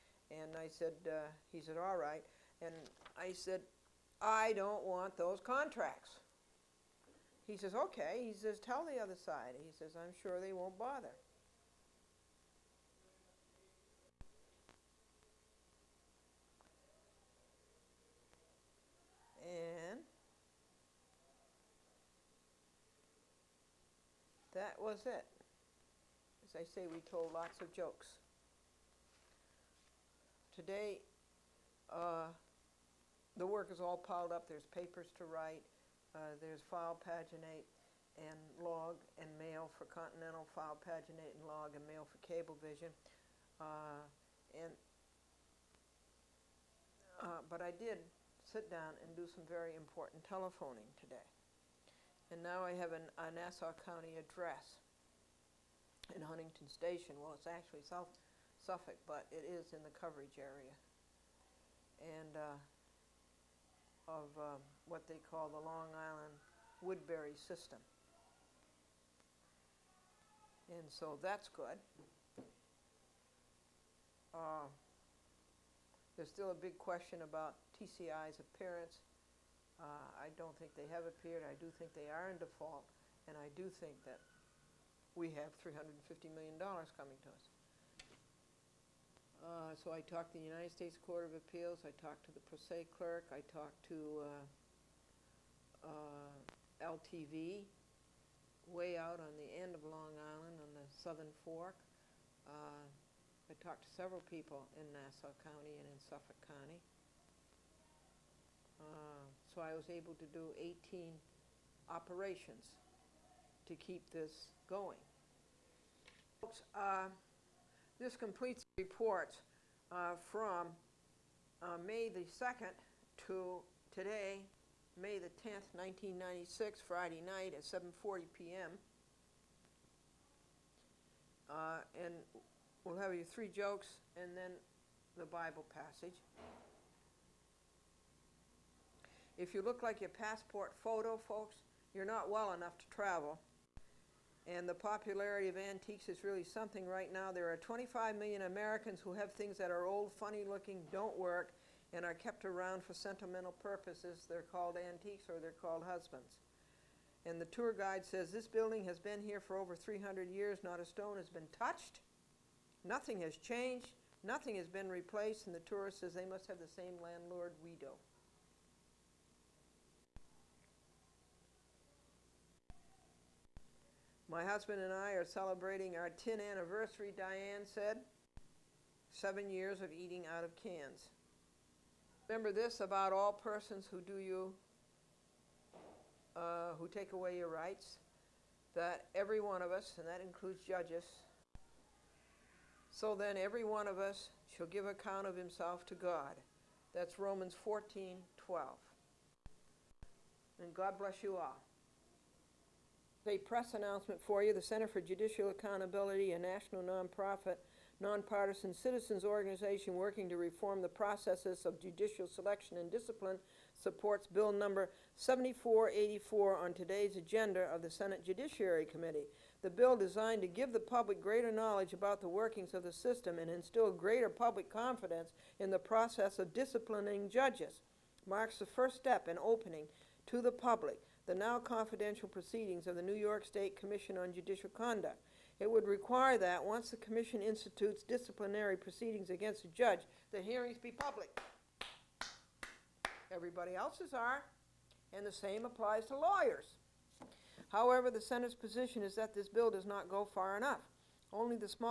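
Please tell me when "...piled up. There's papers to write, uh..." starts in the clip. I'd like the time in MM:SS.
00:33.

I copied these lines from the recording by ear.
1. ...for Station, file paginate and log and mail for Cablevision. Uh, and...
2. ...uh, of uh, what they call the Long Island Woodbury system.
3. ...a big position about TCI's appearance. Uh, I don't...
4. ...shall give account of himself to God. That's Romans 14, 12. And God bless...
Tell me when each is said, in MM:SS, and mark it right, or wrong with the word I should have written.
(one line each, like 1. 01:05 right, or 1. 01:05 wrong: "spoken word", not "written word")
1. 00:39 wrong: "Continental", not "Station"
2. 01:02 right
3. 01:16 wrong: "question", not "position"
4. 03:14 right.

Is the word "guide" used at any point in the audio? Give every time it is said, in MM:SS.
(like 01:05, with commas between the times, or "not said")
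02:37.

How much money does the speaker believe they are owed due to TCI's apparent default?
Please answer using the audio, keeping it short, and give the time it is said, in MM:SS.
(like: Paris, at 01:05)
$350 million, at 01:25.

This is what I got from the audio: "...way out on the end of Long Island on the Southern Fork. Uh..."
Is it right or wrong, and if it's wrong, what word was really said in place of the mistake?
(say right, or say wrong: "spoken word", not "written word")
right.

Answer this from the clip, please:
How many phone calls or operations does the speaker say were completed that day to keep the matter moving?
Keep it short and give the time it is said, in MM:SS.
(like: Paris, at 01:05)
18, at 01:50.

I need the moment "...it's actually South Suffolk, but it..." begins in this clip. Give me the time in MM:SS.
00:57.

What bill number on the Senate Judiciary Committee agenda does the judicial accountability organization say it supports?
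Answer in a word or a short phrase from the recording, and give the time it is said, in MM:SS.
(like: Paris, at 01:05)
7484, at 03:35.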